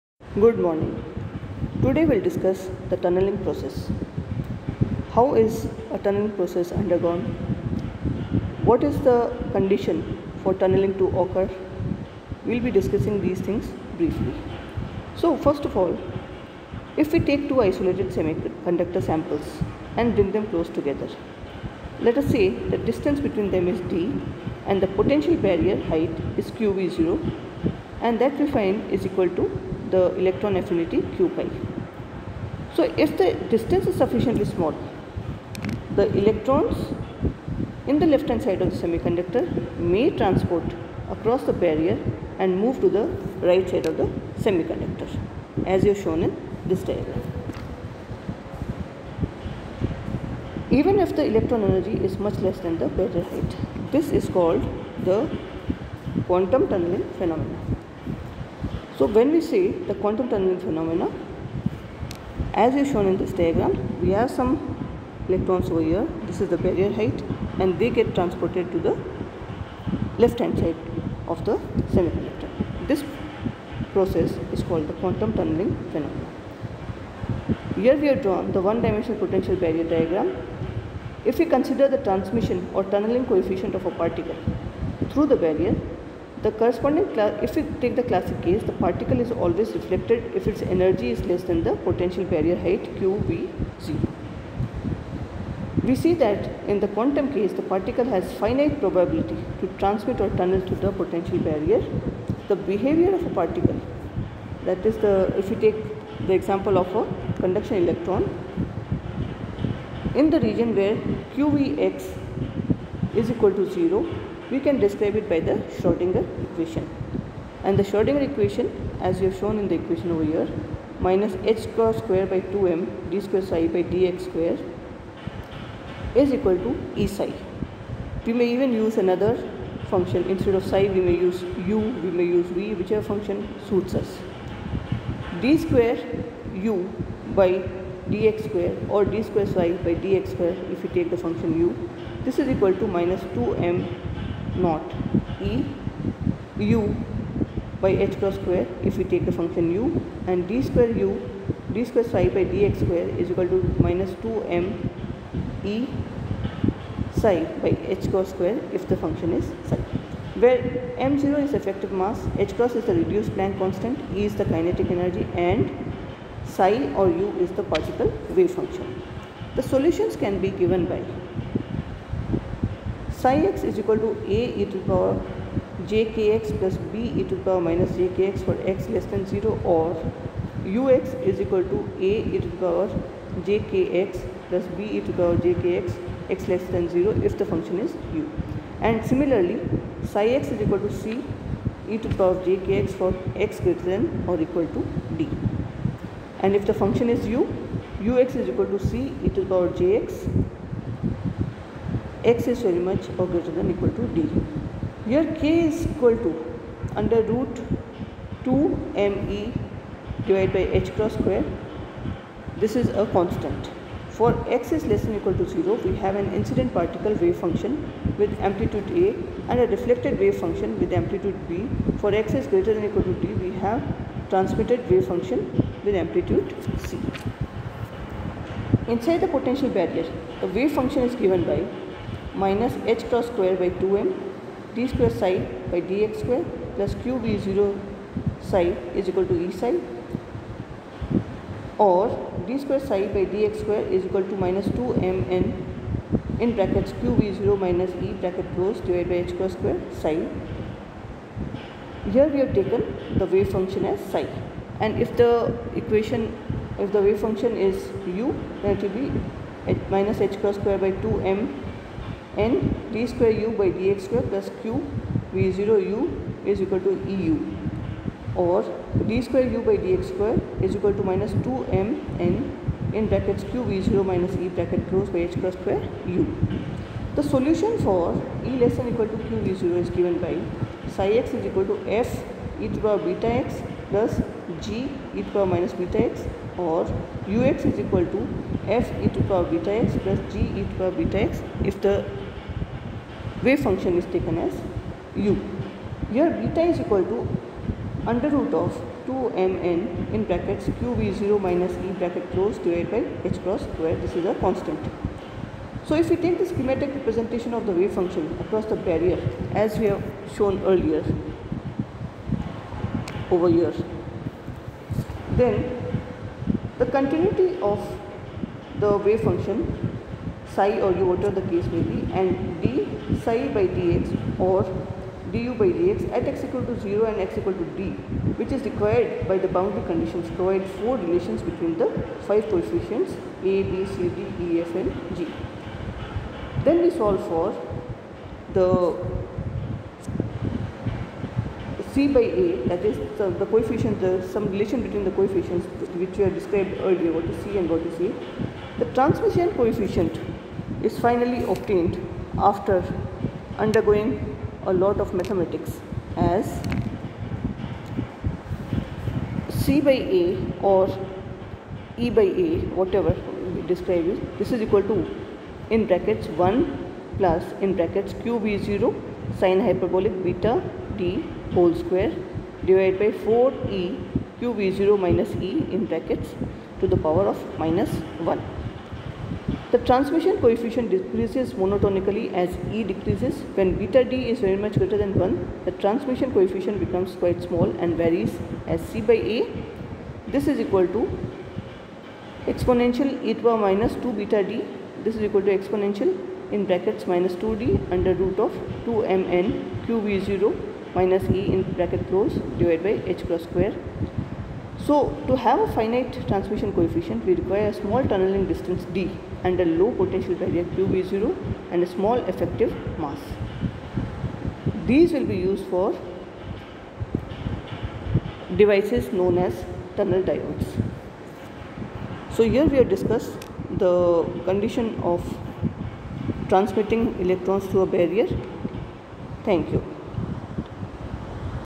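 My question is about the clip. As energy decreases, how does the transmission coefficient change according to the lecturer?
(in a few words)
decreases monotonically.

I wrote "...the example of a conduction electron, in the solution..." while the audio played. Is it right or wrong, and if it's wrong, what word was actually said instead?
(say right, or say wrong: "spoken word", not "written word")
wrong: "region", not "solution".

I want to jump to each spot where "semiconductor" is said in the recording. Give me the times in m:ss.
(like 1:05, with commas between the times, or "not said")
0:18, 0:38, 0:44, 1:11.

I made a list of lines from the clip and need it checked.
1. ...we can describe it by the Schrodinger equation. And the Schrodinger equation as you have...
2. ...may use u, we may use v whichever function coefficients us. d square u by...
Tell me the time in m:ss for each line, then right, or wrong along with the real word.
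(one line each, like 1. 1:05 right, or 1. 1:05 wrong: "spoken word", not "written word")
1. 1:54 right
2. 2:11 wrong: "suits", not "coefficients".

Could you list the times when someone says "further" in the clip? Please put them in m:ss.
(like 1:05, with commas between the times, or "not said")
not said.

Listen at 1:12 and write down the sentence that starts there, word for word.
This process is called the quantum tunneling phenomenon.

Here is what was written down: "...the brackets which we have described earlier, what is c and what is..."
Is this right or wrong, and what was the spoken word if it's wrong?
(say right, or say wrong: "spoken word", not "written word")
wrong: "coefficients", not "brackets".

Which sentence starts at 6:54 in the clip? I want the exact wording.
These will be used for devices known as tunnel diodes.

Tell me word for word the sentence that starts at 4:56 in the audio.
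Here beta is equal to under root of 2mn in brackets qv0 minus e bracket close divided by h cross square.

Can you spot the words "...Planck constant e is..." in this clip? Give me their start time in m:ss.
2:43.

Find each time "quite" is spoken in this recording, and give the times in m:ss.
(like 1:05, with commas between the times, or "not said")
6:27.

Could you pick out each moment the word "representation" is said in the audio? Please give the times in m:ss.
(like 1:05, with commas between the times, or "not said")
5:07.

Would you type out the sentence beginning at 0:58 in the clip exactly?
So when we see the quantum tunneling phenomena, as is shown in this diagram, we have some electrons over here.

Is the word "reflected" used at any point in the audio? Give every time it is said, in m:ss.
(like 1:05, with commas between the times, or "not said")
1:29, 3:39.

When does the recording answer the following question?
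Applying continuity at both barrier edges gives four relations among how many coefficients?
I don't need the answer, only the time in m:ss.
5:32.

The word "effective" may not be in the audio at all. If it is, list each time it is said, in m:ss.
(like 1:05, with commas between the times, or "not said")
2:41, 6:52.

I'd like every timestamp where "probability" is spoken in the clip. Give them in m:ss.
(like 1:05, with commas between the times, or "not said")
1:38.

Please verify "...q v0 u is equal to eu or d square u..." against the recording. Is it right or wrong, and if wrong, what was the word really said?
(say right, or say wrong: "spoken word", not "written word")
right.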